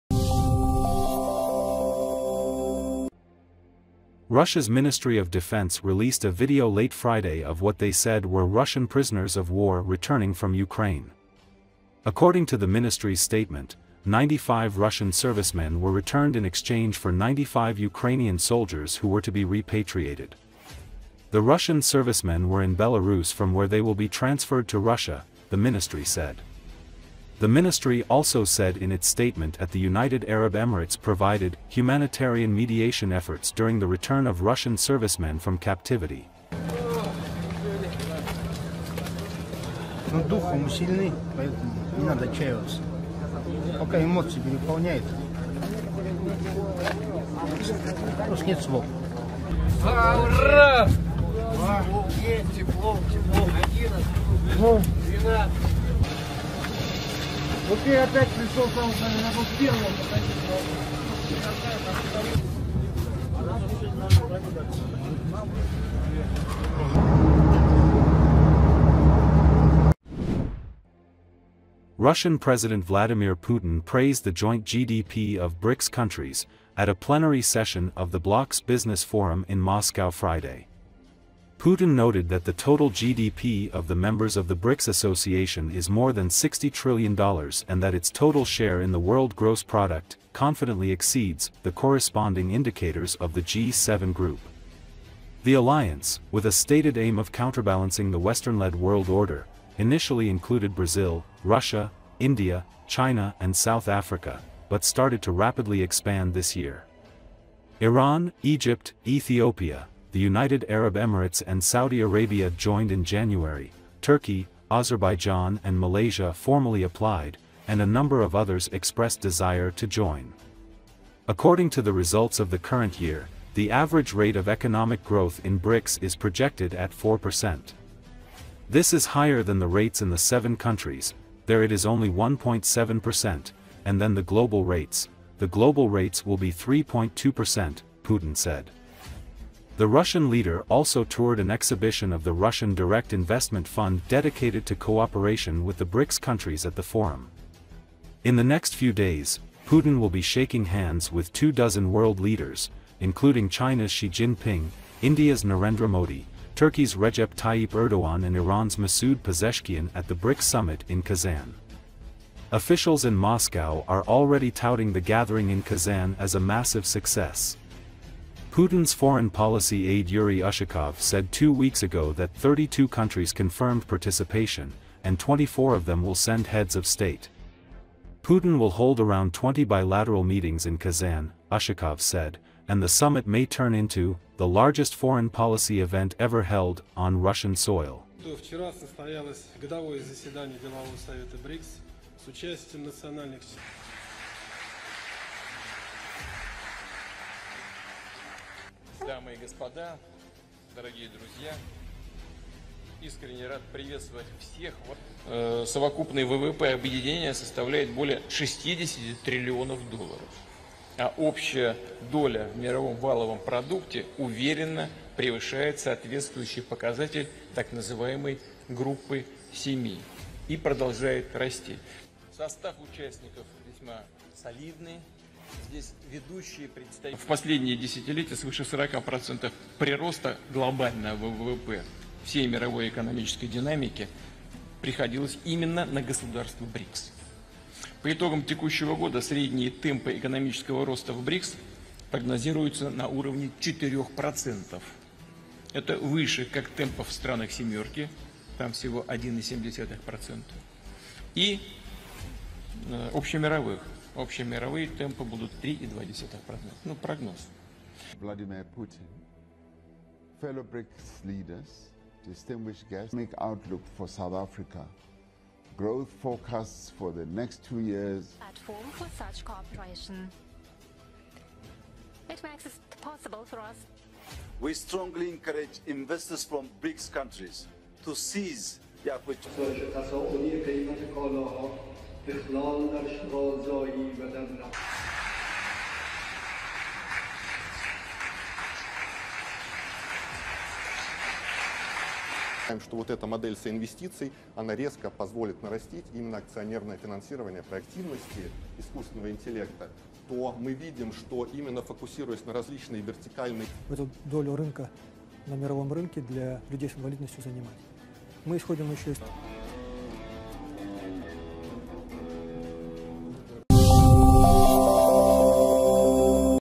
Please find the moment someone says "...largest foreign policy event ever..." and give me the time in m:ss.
3:04.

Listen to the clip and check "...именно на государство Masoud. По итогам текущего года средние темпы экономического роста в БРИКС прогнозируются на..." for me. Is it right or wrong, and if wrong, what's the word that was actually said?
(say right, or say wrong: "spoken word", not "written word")
wrong: "БРИКС", not "Masoud".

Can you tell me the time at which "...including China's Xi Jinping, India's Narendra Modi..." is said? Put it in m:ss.
2:32.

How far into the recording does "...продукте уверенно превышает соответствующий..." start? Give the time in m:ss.
3:33.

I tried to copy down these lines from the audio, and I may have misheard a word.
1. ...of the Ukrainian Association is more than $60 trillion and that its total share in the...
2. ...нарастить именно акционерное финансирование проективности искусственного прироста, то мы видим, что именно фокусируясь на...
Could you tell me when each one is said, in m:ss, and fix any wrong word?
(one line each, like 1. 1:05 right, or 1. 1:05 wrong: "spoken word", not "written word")
1. 1:24 wrong: "BRICS", not "Ukrainian"
2. 4:55 wrong: "интеллекта", not "прироста".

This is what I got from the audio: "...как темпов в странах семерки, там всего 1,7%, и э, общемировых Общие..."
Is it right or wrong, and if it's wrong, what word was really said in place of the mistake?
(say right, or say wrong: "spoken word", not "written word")
right.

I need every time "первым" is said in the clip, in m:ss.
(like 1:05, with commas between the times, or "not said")
0:59.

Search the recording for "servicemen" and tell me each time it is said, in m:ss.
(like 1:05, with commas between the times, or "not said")
0:15, 0:21, 0:34.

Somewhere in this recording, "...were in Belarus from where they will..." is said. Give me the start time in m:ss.
0:22.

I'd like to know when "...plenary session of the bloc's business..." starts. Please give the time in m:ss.
1:16.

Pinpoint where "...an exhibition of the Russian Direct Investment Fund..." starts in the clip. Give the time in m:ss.
2:21.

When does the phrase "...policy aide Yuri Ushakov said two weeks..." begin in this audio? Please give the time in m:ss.
2:49.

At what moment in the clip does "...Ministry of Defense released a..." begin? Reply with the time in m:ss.
0:04.